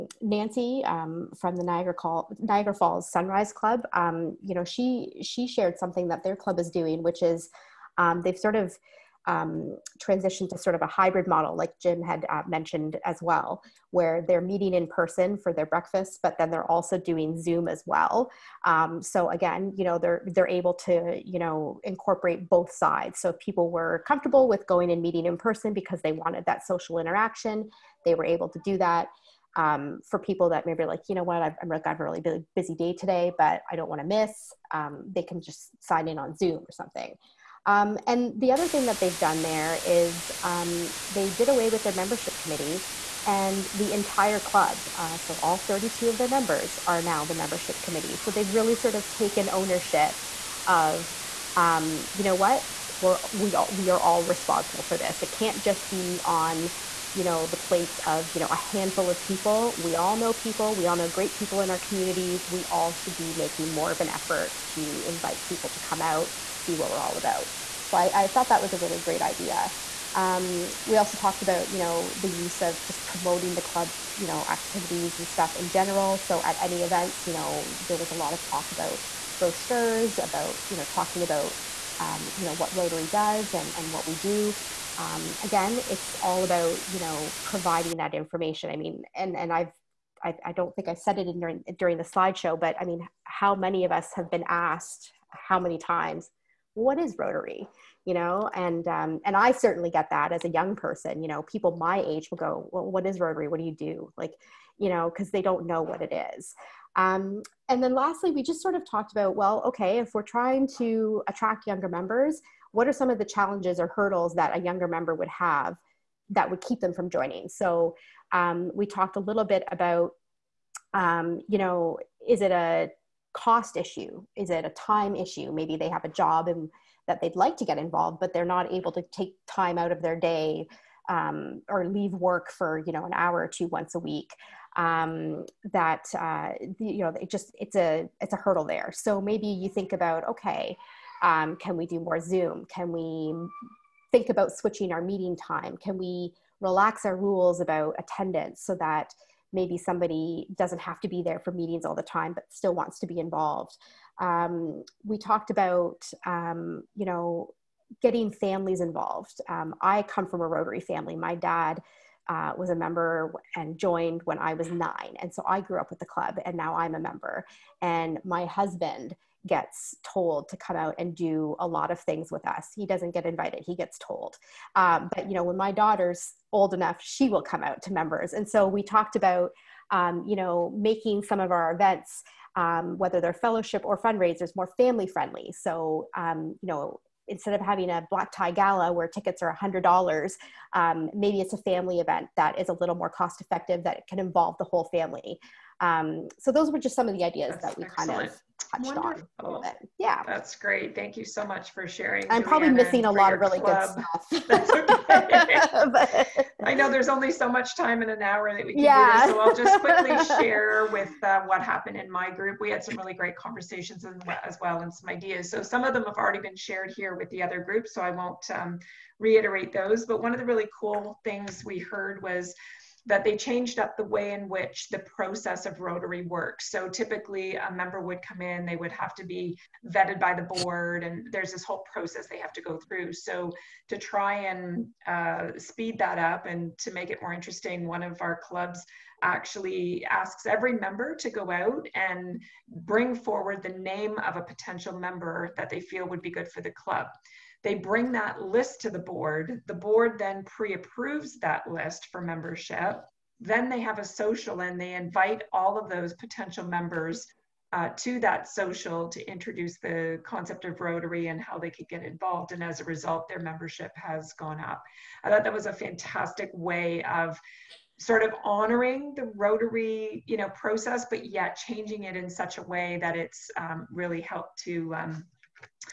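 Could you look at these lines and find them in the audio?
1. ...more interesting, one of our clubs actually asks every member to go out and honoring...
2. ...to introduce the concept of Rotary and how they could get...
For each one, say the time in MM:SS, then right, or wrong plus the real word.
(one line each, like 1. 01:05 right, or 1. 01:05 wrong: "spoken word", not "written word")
1. 03:57 wrong: "bring", not "honoring"
2. 04:19 right.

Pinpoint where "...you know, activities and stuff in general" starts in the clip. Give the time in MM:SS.
01:14.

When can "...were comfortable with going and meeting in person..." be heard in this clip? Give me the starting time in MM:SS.
00:23.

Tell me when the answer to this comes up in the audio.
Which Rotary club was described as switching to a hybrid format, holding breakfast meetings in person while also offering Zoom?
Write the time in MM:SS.
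00:02.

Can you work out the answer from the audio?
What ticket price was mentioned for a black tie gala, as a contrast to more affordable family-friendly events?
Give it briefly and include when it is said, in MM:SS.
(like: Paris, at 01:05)
$100, at 03:09.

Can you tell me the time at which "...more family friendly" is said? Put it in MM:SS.
03:04.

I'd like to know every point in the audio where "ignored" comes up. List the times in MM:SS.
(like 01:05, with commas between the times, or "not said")
not said.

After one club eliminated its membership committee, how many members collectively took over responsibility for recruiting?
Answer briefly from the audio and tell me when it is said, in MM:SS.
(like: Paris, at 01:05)
32, at 00:45.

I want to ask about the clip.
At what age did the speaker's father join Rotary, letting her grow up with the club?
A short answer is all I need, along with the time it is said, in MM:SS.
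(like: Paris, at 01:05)
9, at 02:44.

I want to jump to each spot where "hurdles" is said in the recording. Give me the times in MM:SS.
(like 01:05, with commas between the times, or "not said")
01:53, 02:18.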